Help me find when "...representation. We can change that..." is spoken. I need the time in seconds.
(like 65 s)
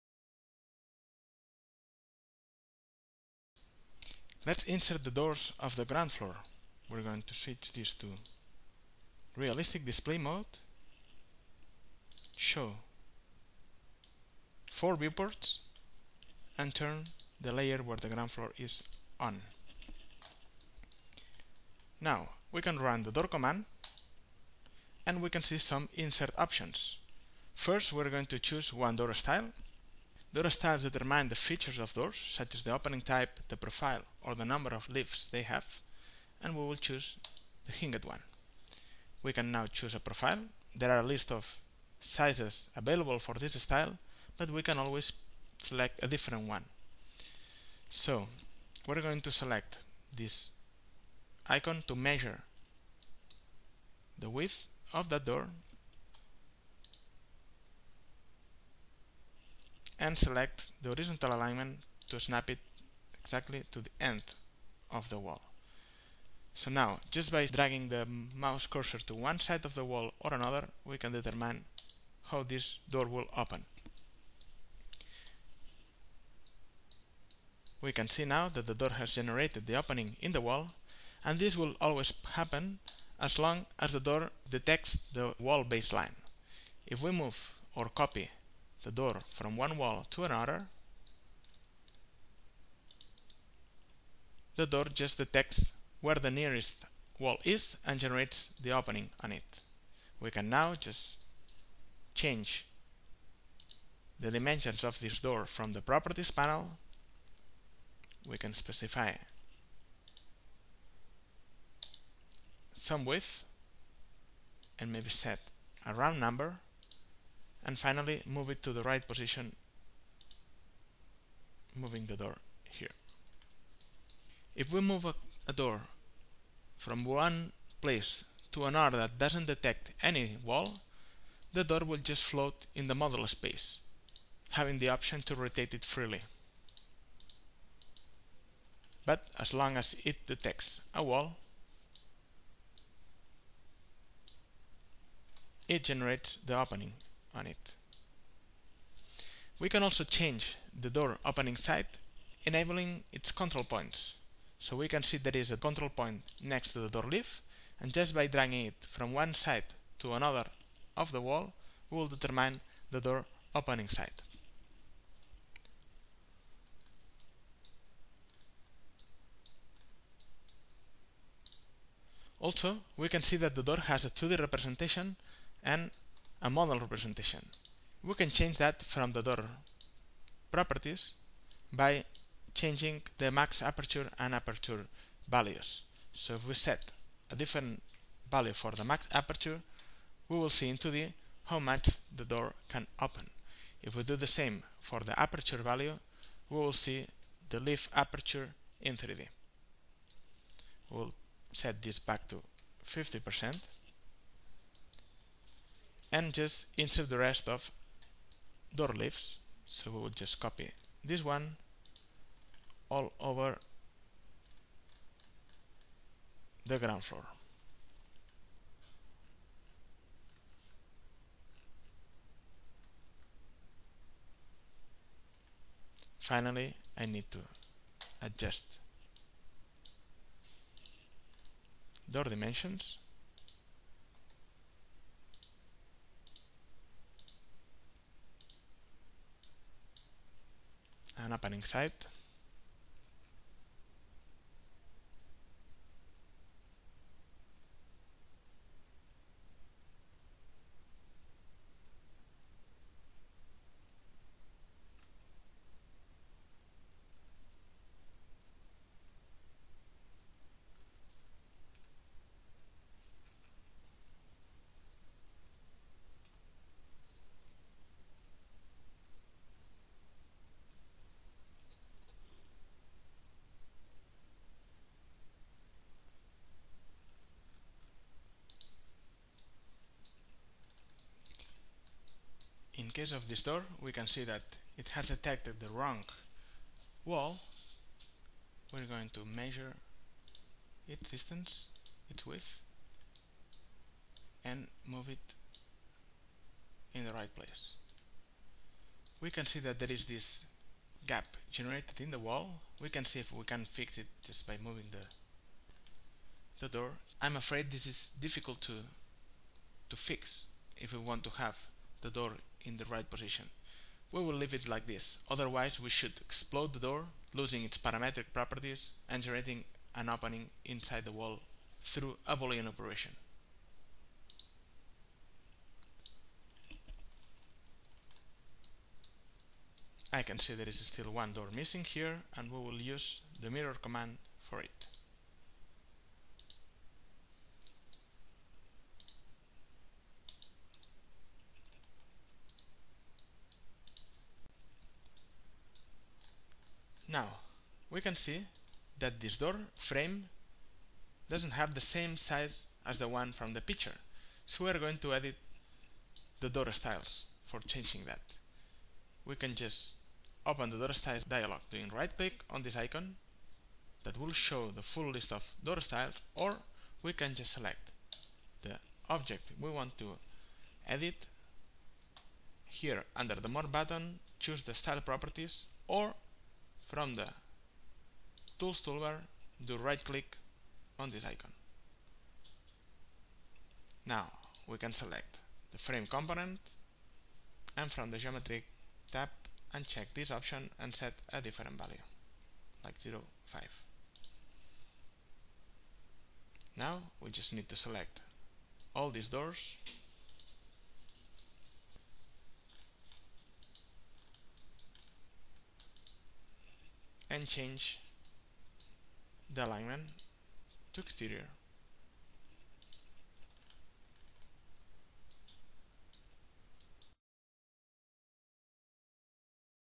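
176 s.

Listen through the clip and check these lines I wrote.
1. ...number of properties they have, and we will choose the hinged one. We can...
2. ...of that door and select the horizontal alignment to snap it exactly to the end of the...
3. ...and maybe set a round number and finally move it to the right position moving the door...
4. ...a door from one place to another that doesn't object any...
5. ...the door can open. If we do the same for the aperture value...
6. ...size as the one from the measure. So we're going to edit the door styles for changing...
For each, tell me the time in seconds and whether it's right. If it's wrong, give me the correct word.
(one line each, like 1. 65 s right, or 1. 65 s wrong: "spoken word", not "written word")
1. 34 s wrong: "leaves", not "properties"
2. 54 s right
3. 114 s right
4. 125 s wrong: "detect", not "object"
5. 192 s right
6. 352 s wrong: "picture", not "measure".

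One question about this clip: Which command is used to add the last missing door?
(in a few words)
Mirror.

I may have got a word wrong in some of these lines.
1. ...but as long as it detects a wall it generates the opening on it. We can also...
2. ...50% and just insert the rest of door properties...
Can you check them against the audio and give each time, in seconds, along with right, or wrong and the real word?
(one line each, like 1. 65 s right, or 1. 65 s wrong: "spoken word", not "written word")
1. 139 s right
2. 202 s wrong: "leaves", not "properties".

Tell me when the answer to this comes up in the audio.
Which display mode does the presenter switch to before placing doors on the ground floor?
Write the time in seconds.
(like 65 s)
9 s.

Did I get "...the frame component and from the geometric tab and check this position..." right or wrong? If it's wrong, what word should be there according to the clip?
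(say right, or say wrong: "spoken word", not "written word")
wrong: "option", not "position".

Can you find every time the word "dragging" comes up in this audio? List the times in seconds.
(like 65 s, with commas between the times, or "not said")
67 s, 158 s.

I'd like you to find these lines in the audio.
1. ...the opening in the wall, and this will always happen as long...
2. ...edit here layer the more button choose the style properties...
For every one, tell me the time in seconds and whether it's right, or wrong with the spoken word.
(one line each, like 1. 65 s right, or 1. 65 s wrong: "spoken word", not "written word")
1. 79 s right
2. 370 s wrong: "under", not "layer".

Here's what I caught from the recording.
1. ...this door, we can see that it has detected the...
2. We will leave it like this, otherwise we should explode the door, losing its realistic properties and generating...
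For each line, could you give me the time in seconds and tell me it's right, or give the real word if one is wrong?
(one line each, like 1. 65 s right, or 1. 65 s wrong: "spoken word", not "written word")
1. 283 s right
2. 314 s wrong: "parametric", not "realistic".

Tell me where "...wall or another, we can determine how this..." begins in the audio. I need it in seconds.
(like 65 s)
69 s.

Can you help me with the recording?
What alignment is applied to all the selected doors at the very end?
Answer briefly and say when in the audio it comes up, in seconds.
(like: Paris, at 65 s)
Exterior, at 411 s.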